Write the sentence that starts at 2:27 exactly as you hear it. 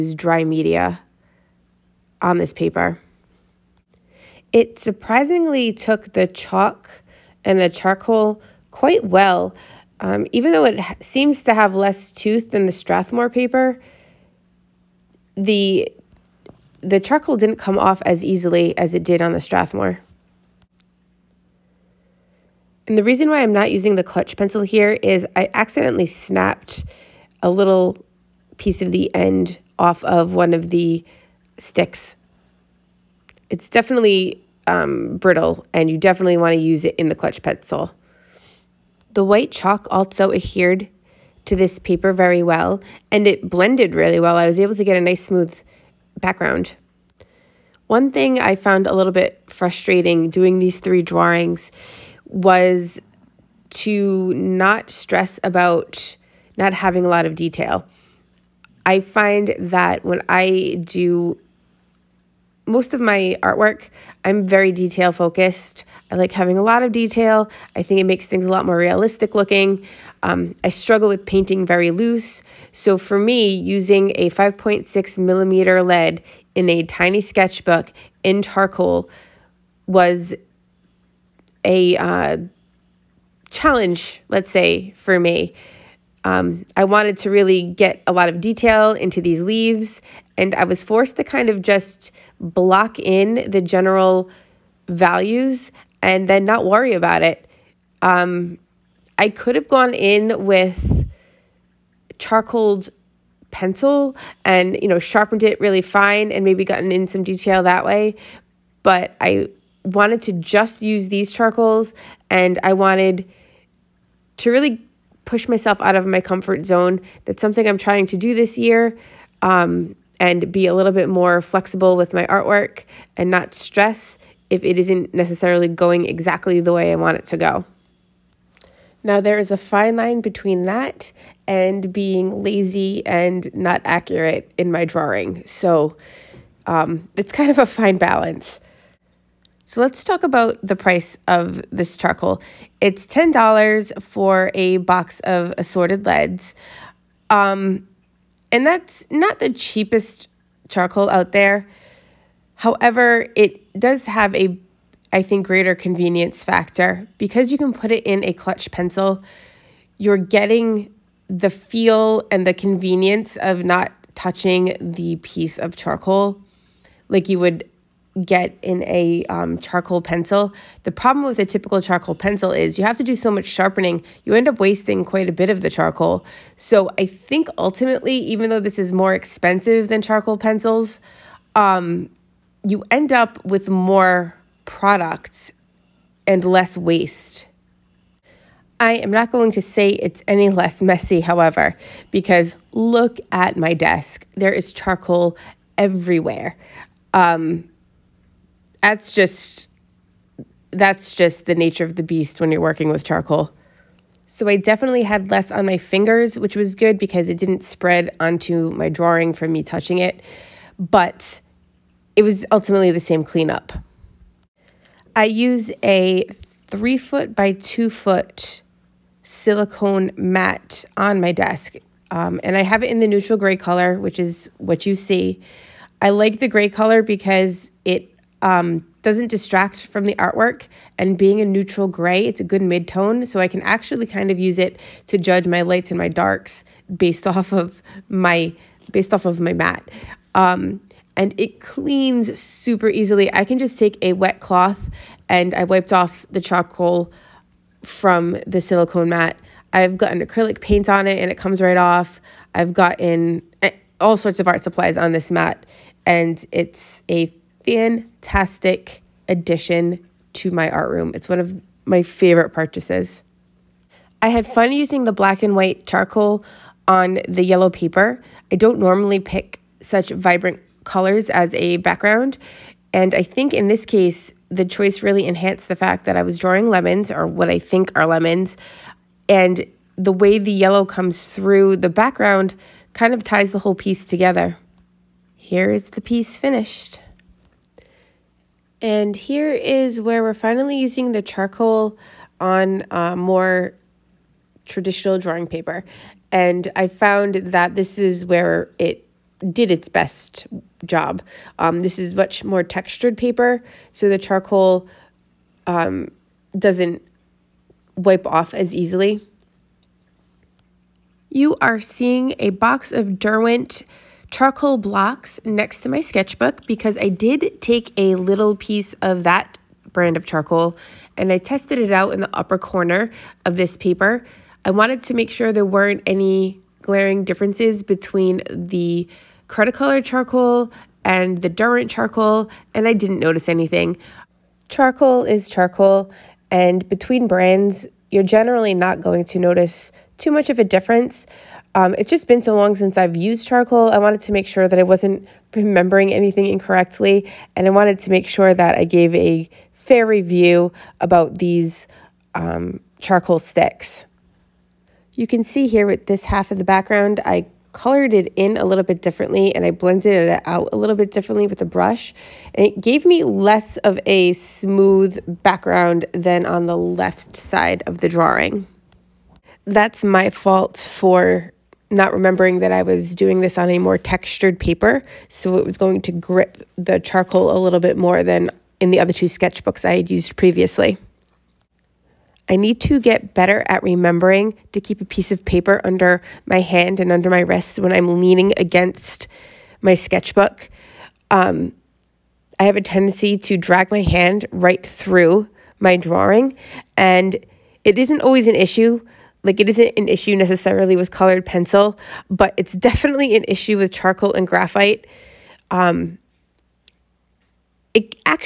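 Um, and that's not the cheapest charcoal out there.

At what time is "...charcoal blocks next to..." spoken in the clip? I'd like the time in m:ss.
5:14.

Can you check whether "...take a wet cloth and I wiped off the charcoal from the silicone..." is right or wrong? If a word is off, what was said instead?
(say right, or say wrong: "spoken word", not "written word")
right.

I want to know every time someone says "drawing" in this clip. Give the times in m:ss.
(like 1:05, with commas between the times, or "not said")
0:51, 2:14, 3:28, 4:36, 4:55, 6:08, 6:35.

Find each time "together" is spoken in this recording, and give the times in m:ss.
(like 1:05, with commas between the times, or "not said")
4:44.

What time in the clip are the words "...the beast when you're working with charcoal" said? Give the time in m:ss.
3:21.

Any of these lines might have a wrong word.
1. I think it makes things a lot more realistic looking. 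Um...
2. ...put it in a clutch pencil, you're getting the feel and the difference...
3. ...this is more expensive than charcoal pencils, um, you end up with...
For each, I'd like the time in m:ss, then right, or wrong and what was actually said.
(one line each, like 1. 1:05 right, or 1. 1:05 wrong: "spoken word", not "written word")
1. 1:07 right
2. 2:37 wrong: "convenience", not "difference"
3. 2:58 right.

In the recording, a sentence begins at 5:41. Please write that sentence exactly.
Um, it's just been so long since I've used charcoal.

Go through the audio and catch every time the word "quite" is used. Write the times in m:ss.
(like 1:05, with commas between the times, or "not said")
0:08, 2:55.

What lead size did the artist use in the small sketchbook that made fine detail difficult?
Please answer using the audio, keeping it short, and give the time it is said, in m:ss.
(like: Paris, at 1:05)
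5.6 millimeter, at 1:14.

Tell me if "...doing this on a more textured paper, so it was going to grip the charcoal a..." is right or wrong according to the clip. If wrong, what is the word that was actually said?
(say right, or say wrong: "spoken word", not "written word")
right.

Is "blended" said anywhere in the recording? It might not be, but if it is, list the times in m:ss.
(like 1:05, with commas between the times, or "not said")
0:43, 5:59.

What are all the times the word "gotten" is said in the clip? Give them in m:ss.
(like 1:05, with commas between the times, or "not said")
1:46, 4:12.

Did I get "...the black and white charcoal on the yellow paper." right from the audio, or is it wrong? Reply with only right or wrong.
right.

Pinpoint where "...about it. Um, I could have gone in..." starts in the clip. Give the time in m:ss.
1:36.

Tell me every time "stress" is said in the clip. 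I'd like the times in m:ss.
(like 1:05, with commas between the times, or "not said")
0:54, 2:03.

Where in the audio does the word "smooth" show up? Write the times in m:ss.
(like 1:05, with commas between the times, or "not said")
0:45, 6:04.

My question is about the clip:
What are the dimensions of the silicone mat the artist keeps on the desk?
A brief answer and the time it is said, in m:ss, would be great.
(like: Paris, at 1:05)
3 foot by 2 foot, at 3:36.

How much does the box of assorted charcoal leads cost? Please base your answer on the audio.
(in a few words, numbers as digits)
$10.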